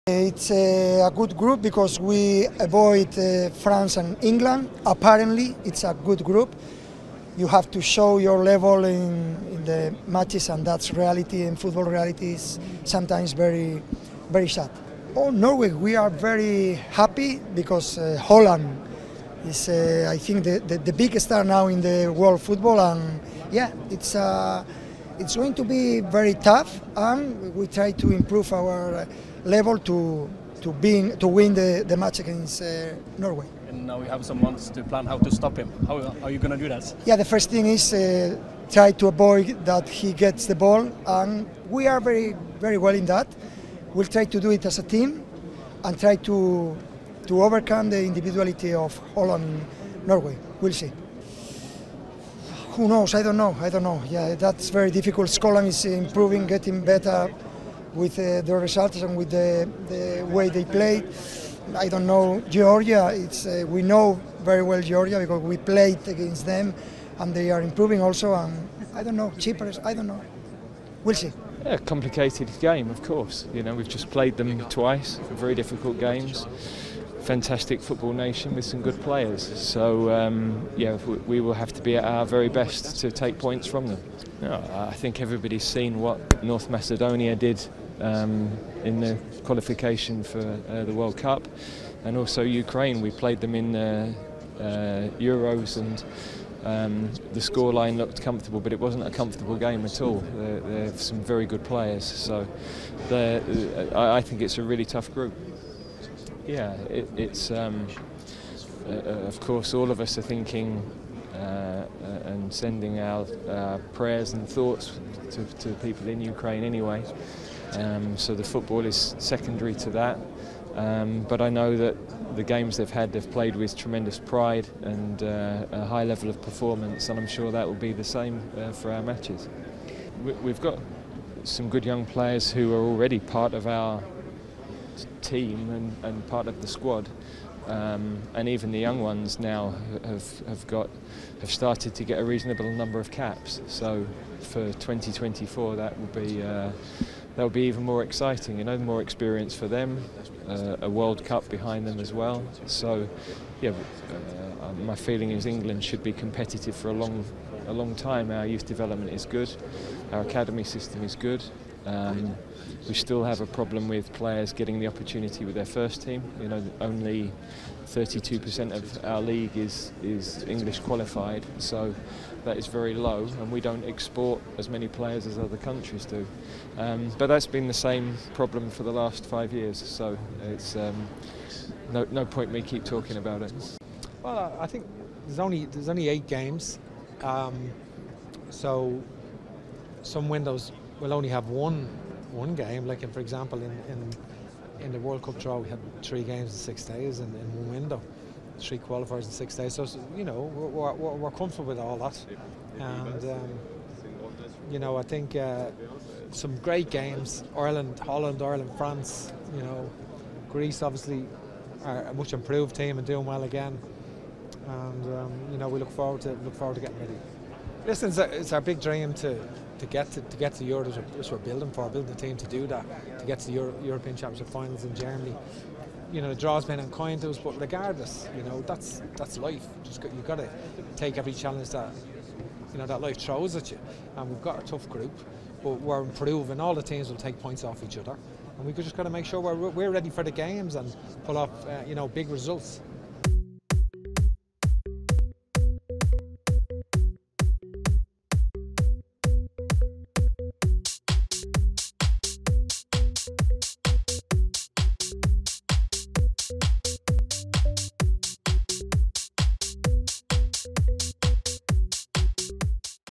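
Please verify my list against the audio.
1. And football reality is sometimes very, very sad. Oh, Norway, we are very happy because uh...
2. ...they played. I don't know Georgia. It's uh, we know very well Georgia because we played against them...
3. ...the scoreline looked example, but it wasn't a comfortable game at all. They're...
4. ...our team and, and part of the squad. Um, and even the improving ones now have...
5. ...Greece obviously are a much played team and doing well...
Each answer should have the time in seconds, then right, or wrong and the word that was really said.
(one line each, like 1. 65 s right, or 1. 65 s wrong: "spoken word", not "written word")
1. 11 s right
2. 60 s right
3. 97 s wrong: "comfortable", not "example"
4. 133 s wrong: "young", not "improving"
5. 210 s wrong: "improved", not "played".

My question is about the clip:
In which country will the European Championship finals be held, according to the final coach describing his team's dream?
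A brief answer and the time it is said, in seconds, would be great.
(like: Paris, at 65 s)
Germany, at 224 s.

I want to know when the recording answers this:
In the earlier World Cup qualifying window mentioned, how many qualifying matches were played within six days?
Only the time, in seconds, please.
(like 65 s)
198 s.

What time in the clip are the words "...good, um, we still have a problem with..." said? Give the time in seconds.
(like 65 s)
161 s.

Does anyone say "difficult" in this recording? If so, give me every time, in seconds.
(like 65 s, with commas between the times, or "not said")
54 s, 75 s.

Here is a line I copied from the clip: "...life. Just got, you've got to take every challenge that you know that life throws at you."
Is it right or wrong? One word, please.
right.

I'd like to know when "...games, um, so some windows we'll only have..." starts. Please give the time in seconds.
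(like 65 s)
186 s.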